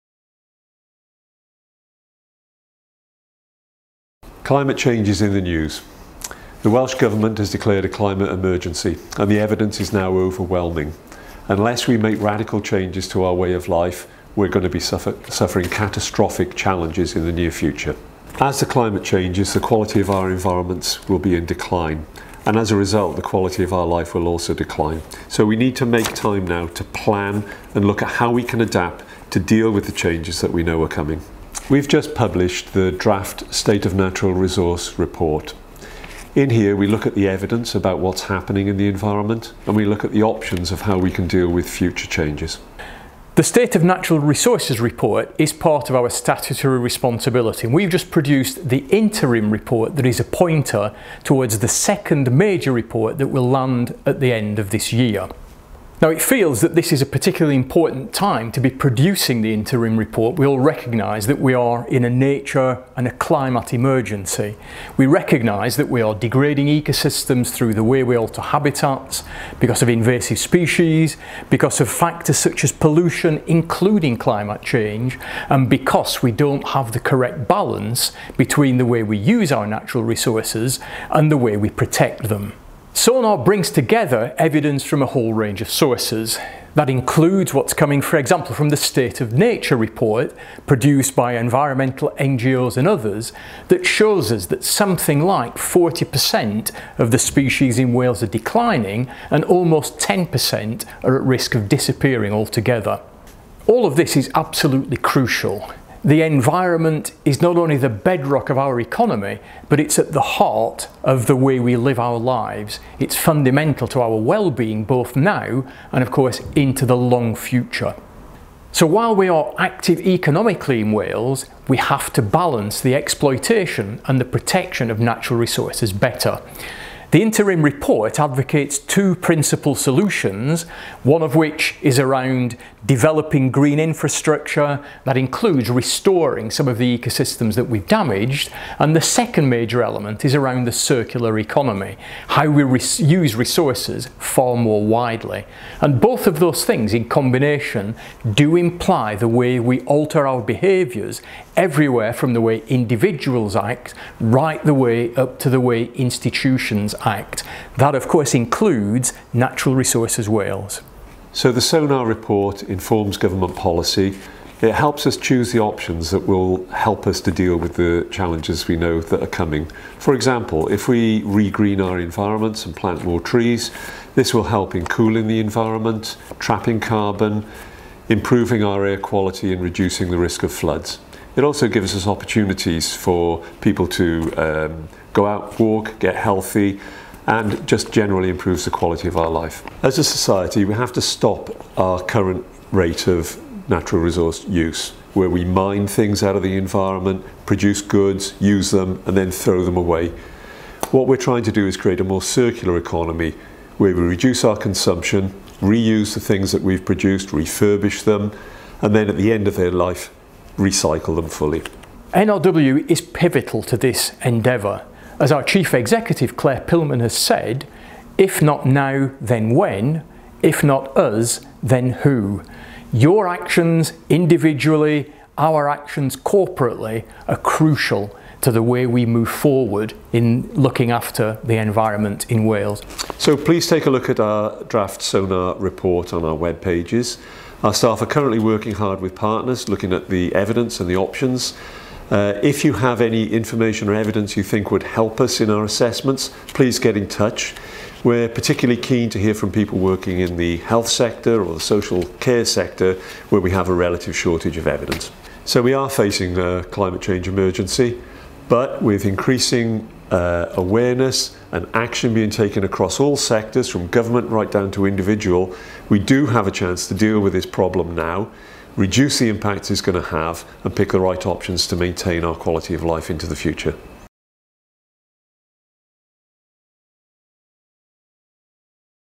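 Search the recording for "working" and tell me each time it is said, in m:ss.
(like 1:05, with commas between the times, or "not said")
3:58, 4:09.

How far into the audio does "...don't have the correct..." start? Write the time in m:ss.
1:16.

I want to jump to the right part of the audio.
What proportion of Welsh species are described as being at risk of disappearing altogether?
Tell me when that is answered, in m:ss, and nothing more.
1:39.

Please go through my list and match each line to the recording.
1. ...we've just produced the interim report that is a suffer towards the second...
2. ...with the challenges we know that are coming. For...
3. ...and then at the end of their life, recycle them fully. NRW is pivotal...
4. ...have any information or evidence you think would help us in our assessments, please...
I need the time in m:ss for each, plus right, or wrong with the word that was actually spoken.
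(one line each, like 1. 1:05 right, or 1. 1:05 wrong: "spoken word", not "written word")
1. 0:47 wrong: "pointer", not "suffer"
2. 2:47 right
3. 3:28 right
4. 4:02 right.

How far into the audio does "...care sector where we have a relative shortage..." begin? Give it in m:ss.
4:12.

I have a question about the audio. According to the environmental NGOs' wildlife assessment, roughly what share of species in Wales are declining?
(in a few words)
40%.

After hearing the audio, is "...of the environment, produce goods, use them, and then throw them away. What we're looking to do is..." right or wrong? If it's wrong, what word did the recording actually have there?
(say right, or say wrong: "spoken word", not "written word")
wrong: "trying", not "looking".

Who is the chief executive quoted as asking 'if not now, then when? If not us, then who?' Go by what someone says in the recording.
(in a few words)
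Clare Pillman.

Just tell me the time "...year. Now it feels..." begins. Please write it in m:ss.
0:54.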